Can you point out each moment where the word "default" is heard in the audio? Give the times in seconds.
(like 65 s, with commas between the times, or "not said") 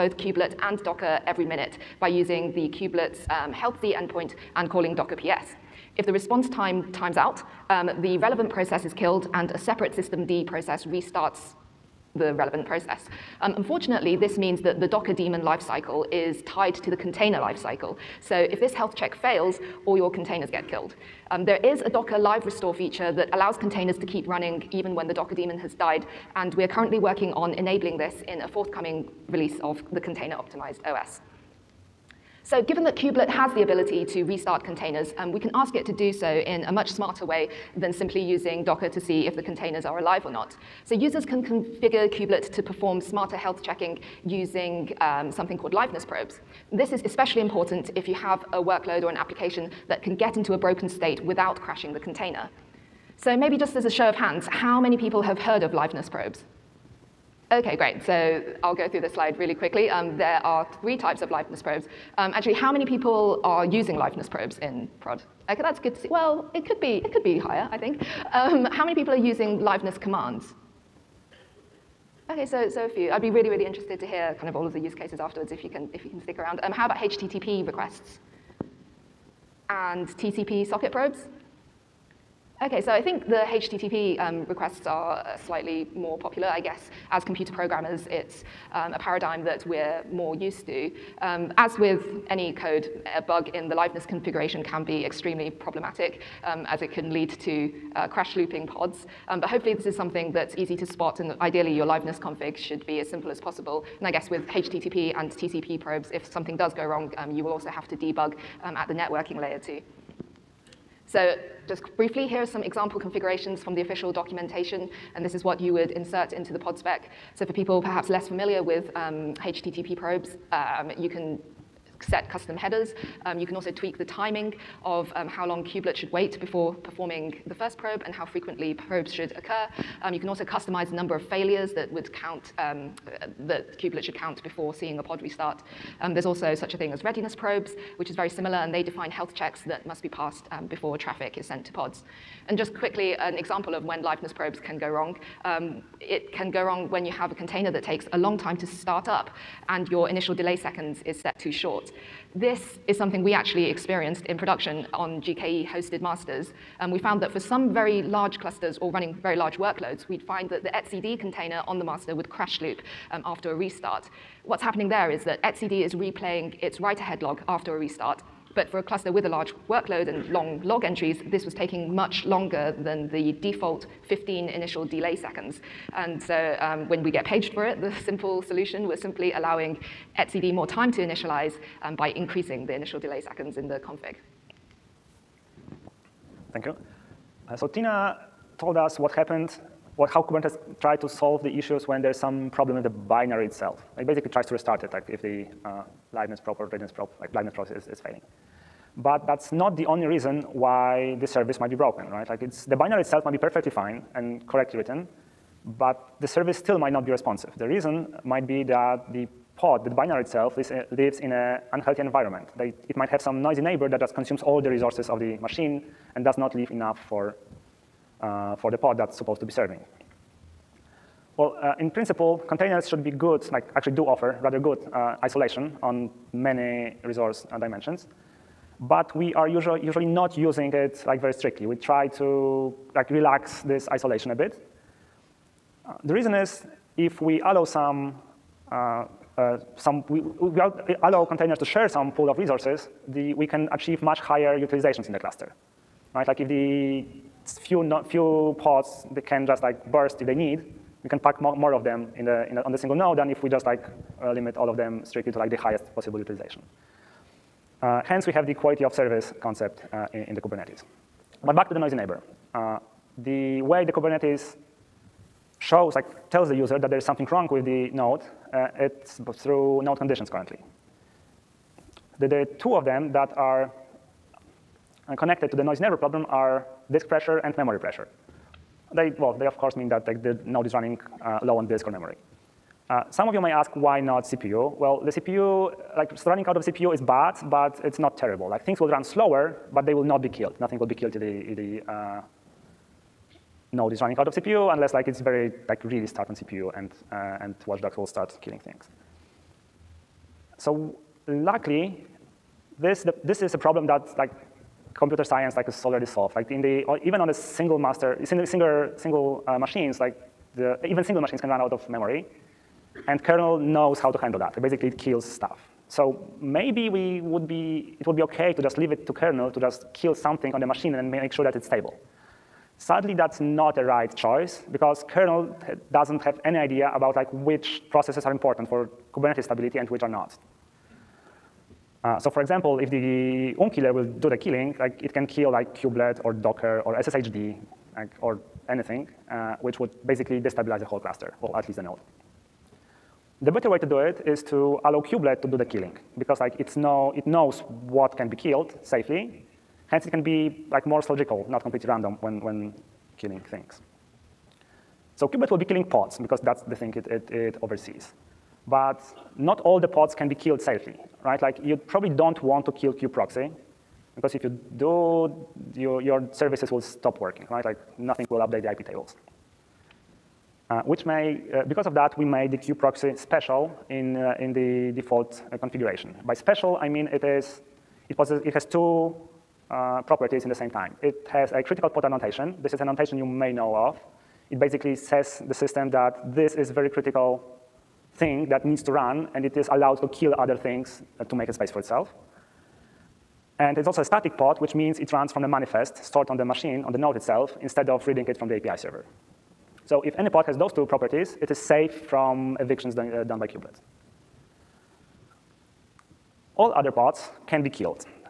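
173 s, 374 s.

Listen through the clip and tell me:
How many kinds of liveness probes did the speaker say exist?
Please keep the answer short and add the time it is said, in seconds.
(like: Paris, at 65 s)
3, at 60 s.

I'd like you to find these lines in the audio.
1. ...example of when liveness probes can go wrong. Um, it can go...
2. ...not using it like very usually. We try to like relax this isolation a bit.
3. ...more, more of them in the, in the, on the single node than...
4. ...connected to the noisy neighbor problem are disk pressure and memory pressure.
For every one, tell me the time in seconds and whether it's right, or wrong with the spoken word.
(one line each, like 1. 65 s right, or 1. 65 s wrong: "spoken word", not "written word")
1. 143 s right
2. 230 s wrong: "strictly", not "usually"
3. 251 s right
4. 275 s right.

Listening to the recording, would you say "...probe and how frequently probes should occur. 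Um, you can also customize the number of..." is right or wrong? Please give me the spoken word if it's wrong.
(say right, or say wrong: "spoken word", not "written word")
right.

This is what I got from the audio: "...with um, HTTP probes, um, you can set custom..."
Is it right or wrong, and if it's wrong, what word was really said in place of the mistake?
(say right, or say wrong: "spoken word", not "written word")
right.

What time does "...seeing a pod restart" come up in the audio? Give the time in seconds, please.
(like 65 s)
134 s.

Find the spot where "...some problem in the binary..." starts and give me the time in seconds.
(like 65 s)
192 s.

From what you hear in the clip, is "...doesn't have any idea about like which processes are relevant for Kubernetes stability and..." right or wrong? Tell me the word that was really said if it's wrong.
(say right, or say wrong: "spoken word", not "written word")
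wrong: "important", not "relevant".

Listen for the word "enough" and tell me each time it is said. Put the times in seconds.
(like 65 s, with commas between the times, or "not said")
216 s.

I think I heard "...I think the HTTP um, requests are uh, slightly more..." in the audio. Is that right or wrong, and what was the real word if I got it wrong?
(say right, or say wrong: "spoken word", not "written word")
right.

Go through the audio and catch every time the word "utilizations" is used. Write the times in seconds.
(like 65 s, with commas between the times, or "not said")
244 s, 256 s.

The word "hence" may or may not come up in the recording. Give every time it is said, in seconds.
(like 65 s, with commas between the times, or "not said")
258 s, 349 s.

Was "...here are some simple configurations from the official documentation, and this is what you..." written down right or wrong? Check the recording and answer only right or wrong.
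wrong.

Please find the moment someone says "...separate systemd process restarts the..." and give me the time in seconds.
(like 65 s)
9 s.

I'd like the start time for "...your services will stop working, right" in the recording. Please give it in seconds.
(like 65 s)
365 s.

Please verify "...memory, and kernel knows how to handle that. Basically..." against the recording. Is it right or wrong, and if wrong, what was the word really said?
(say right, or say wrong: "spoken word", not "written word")
right.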